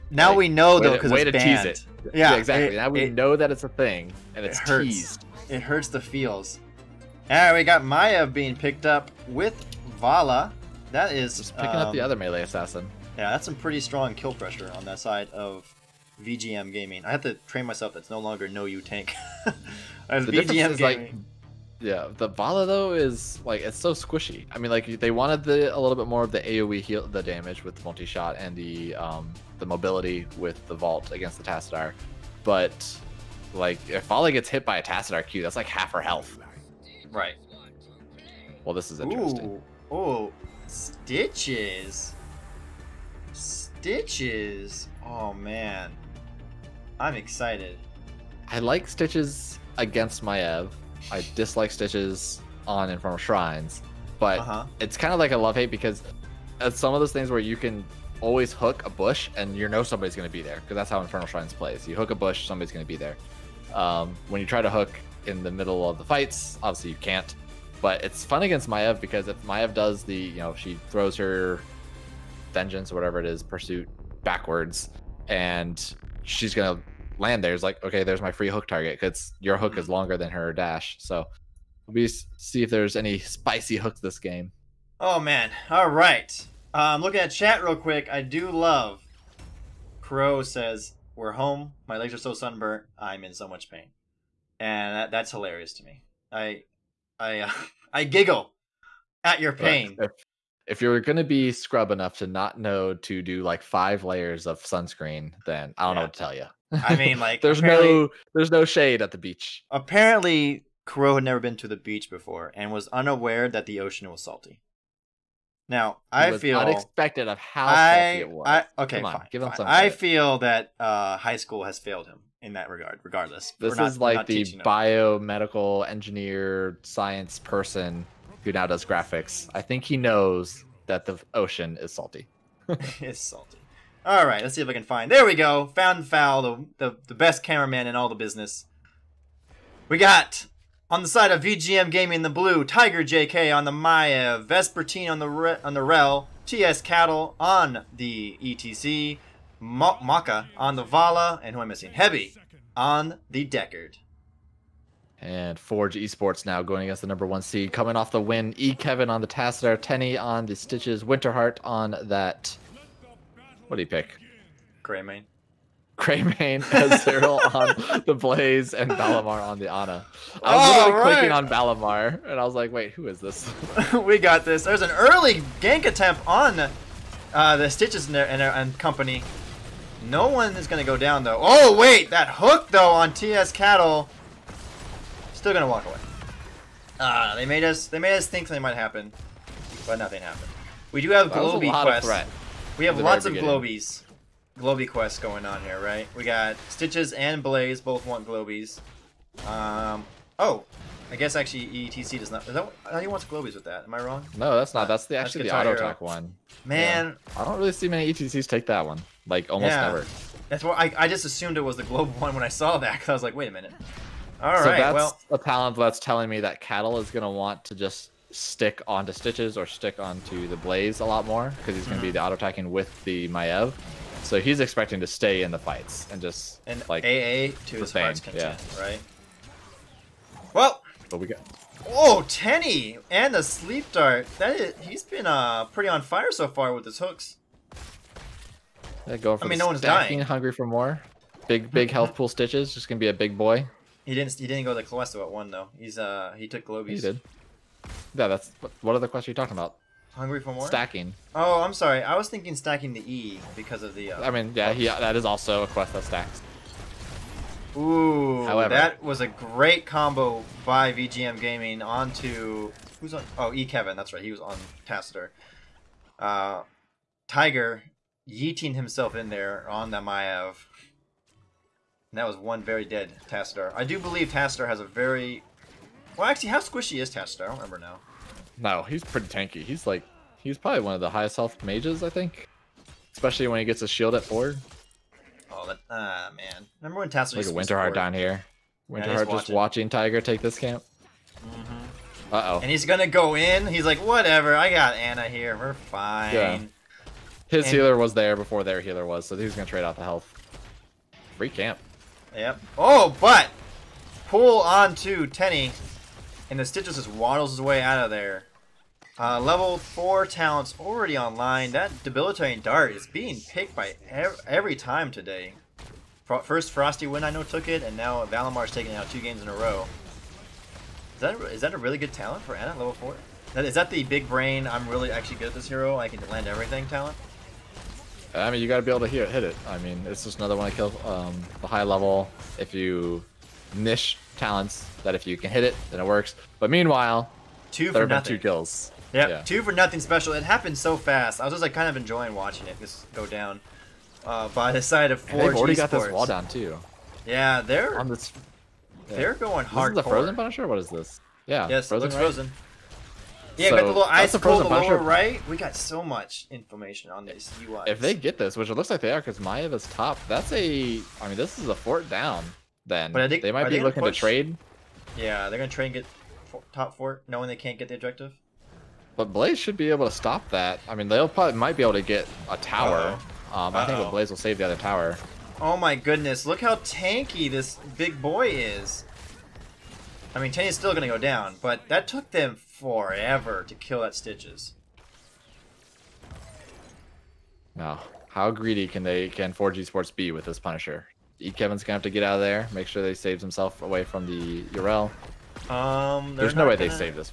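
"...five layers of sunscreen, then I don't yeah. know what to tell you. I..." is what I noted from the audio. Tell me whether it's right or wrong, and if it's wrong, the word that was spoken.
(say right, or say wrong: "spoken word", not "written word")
right.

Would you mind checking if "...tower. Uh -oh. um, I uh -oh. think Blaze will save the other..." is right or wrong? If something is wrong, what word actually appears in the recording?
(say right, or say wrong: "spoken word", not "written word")
right.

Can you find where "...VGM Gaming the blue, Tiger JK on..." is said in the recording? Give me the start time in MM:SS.
02:21.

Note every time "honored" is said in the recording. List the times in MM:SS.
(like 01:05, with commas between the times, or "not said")
not said.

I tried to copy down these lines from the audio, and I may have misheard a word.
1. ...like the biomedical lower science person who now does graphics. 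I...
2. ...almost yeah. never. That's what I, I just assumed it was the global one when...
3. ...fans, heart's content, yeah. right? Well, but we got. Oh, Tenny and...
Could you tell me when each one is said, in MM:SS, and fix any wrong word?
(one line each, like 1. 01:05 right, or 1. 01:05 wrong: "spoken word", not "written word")
1. 02:03 wrong: "engineer", not "lower"
2. 03:29 right
3. 03:47 right.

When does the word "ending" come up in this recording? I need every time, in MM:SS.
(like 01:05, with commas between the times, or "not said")
not said.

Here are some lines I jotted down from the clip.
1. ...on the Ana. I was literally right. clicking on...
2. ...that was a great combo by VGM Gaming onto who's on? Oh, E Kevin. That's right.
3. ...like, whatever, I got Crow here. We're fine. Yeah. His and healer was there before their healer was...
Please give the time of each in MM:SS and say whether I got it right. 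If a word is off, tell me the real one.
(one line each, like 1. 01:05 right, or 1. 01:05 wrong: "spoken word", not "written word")
1. 02:49 right
2. 04:18 right
3. 04:53 wrong: "Ana", not "Crow".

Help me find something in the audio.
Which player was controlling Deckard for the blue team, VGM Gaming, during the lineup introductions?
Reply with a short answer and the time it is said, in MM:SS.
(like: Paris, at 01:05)
Heavy, at 02:31.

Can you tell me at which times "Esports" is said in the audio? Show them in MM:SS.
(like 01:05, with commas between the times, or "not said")
02:35, 06:29.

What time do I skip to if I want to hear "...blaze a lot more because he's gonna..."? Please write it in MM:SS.
03:40.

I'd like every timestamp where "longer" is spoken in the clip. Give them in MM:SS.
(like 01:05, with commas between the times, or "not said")
00:18, 01:19.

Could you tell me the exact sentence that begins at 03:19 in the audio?
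Um, oh, I guess actually ETC does not.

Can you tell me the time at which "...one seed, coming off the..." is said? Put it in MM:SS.
02:37.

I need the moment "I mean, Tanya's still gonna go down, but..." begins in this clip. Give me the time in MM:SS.
06:20.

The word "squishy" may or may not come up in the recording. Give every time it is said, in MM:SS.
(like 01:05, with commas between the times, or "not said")
00:23, 04:36.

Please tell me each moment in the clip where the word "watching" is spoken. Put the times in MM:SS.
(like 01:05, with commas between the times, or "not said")
04:49, 05:42.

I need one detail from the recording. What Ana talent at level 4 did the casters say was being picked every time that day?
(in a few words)
Debilitating Dart.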